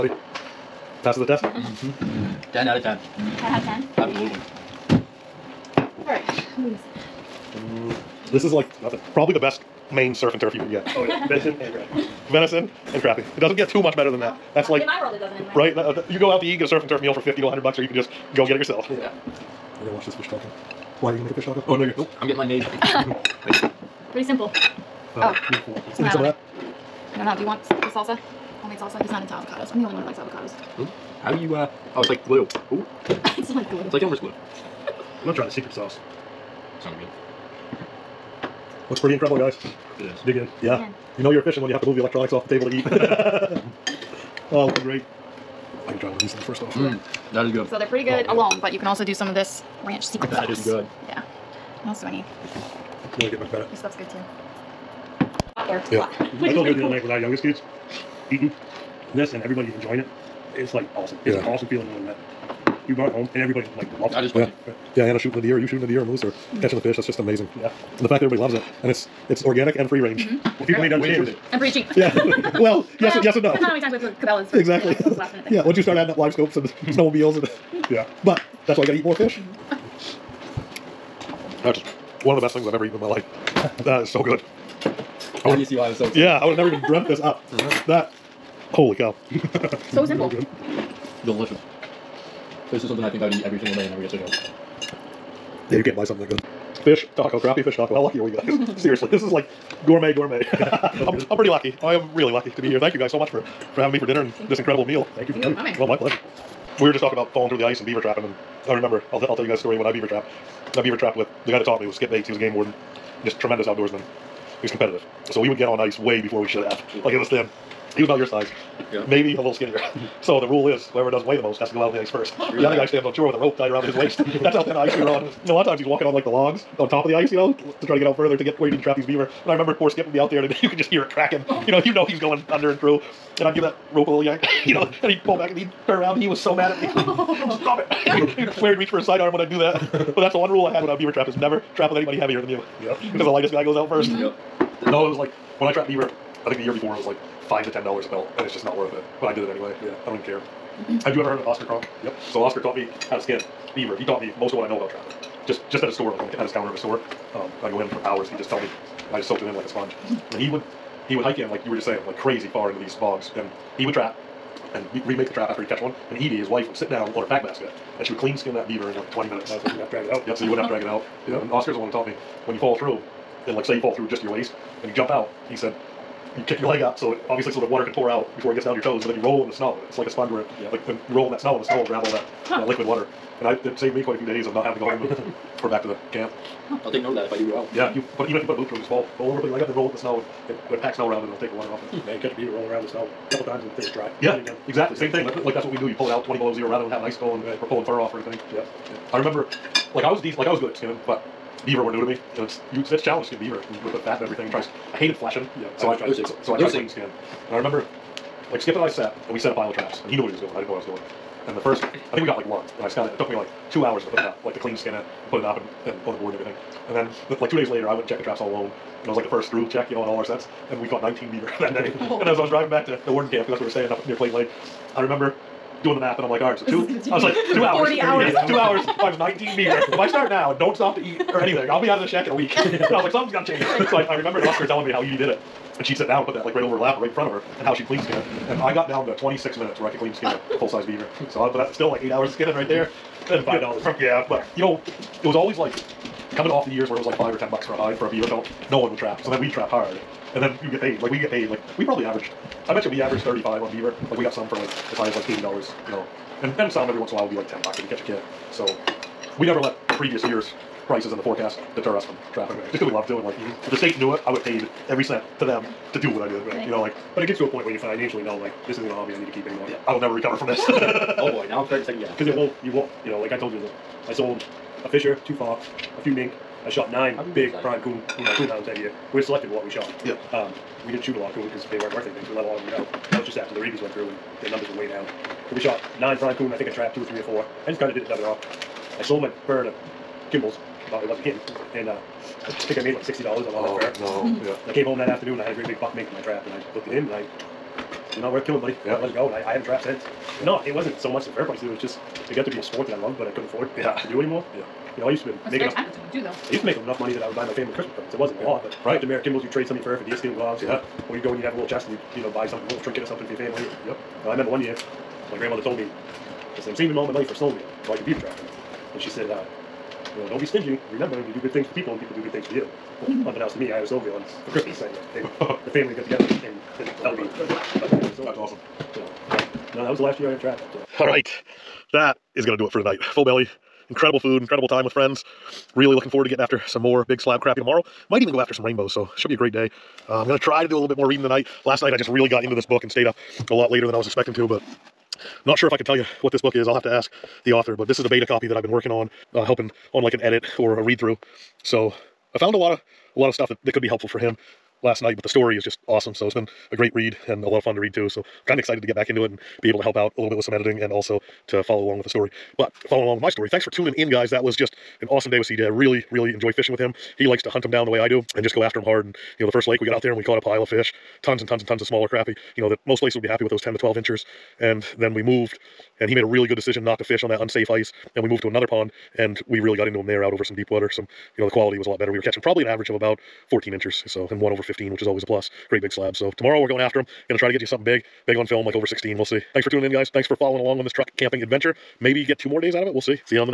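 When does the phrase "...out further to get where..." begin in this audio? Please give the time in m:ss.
2:08.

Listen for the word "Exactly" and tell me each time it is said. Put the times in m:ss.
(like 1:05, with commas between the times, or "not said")
1:14, 3:14.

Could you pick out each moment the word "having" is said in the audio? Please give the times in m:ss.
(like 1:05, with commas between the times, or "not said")
1:43, 3:04, 3:16.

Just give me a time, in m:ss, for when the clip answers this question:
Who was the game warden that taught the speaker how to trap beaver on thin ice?
1:51.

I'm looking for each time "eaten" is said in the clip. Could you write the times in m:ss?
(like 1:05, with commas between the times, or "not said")
1:22.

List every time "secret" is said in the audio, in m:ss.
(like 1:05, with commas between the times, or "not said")
0:35, 0:50.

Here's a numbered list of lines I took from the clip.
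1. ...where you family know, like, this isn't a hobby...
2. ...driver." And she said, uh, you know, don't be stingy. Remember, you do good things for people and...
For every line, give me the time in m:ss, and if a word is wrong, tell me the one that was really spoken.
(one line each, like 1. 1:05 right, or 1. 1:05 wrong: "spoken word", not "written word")
1. 4:27 wrong: "financially", not "family"
2. 5:18 right.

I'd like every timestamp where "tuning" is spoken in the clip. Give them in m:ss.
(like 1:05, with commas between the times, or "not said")
6:03, 6:29.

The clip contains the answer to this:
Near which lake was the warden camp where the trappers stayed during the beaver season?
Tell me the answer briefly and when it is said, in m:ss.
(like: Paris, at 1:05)
Clayton Lake, at 3:44.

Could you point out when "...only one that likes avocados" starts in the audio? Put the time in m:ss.
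0:29.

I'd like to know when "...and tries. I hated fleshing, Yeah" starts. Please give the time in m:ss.
3:24.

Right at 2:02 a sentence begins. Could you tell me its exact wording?
guy stands on shore with a rope tied around his waist.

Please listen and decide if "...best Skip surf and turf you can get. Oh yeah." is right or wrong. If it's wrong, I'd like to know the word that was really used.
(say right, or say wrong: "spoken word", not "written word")
wrong: "Maine", not "Skip".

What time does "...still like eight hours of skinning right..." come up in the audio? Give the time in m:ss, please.
4:01.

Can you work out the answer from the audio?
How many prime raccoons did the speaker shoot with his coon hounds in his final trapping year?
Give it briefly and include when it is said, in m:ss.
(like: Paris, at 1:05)
9, at 4:36.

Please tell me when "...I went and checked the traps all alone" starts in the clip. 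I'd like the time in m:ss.
3:37.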